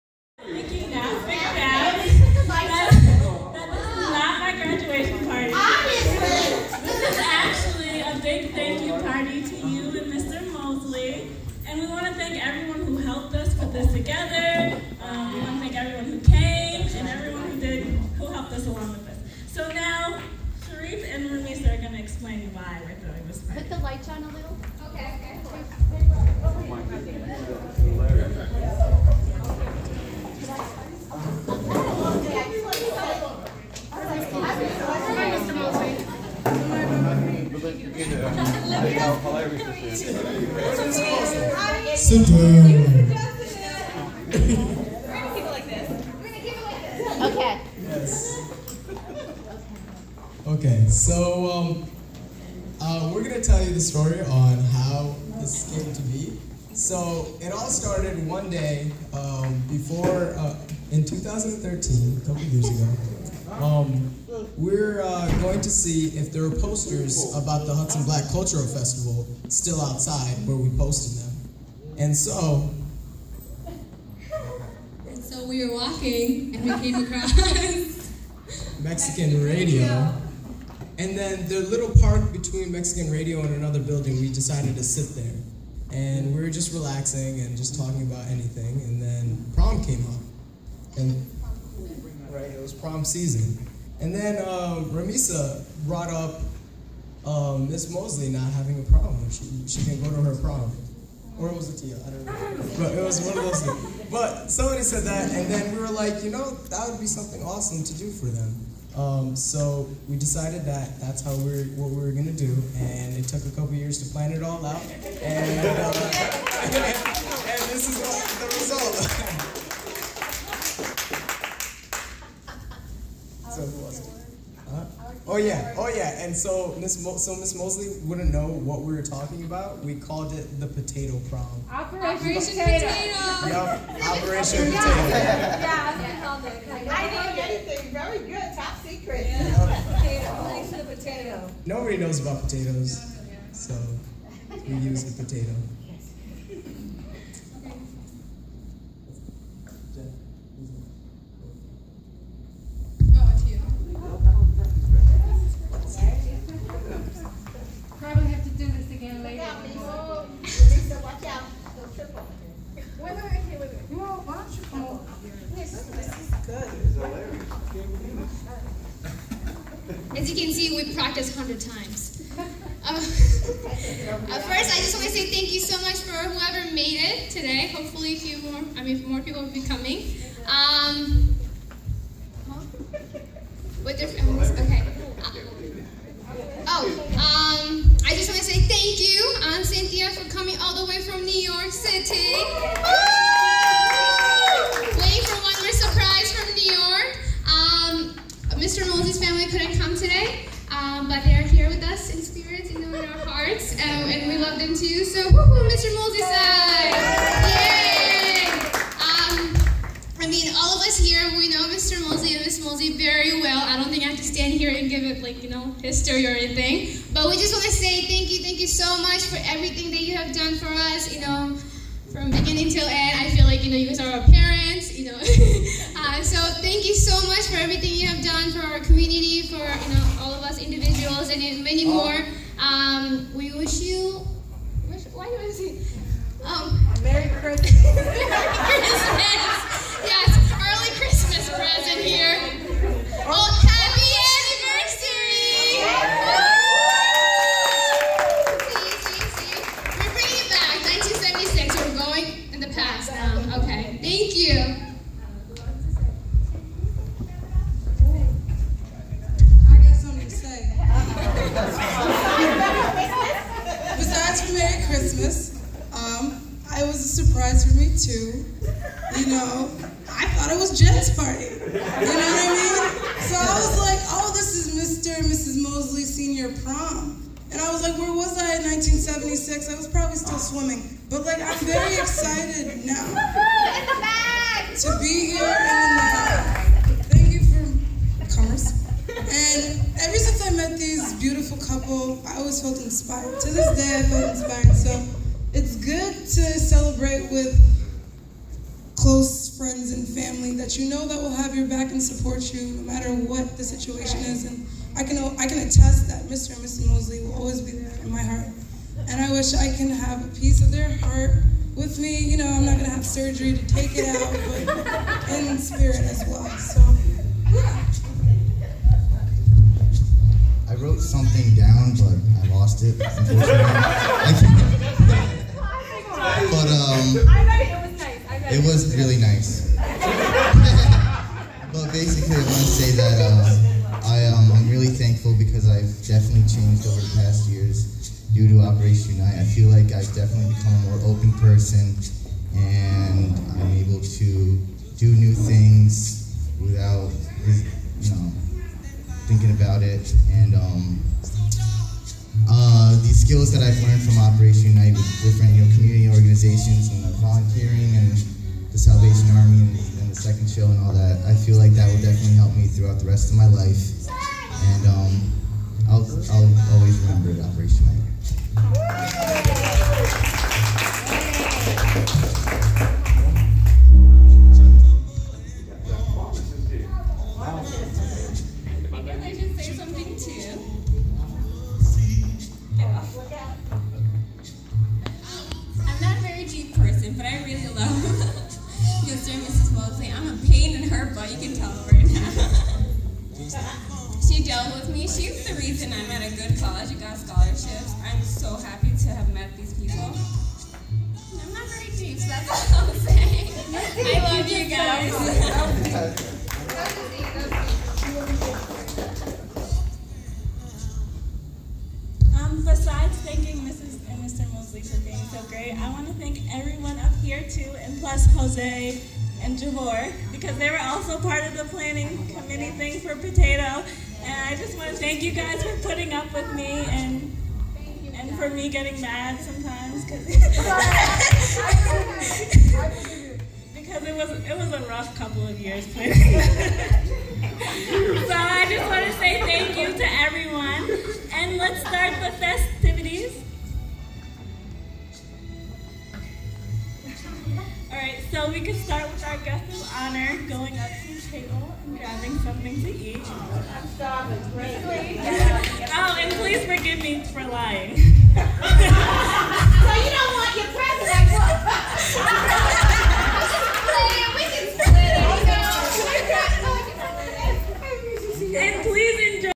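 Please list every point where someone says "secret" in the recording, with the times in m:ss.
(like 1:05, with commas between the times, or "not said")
2:18.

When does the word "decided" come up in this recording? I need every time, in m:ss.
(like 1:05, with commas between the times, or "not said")
1:24, 1:50.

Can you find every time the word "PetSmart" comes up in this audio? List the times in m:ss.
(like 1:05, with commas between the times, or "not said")
not said.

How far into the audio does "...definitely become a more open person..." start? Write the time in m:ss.
5:40.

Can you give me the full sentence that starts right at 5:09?
And I wish I can have a piece of their heart with me.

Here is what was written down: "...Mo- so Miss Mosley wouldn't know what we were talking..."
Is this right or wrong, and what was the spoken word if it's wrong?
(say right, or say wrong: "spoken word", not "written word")
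right.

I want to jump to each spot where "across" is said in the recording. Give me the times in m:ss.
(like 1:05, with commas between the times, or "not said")
1:17.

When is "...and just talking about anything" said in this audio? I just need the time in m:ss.
1:27.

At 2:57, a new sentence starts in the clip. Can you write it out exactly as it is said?
Hopefully, a few more, I mean, more people will be coming.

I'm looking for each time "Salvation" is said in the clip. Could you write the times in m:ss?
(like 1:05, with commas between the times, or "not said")
5:58.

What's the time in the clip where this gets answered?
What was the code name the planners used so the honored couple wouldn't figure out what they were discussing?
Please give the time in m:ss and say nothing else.
2:12.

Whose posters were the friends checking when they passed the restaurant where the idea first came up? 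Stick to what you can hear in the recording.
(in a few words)
Hudson Black Cultural Festival.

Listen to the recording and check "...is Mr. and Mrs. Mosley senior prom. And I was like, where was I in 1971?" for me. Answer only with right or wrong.
wrong.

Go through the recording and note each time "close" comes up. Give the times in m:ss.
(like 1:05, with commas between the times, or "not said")
4:58.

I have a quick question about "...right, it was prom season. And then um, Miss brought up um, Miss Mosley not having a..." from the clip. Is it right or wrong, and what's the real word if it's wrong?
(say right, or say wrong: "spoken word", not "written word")
wrong: "Ramisa", not "Miss".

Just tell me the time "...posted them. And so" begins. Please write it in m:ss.
1:10.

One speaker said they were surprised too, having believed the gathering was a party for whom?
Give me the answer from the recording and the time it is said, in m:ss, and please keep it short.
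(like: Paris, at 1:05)
Jen, at 4:30.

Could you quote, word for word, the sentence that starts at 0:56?
So it all started one day um, before, uh, in 2013, a couple years ago.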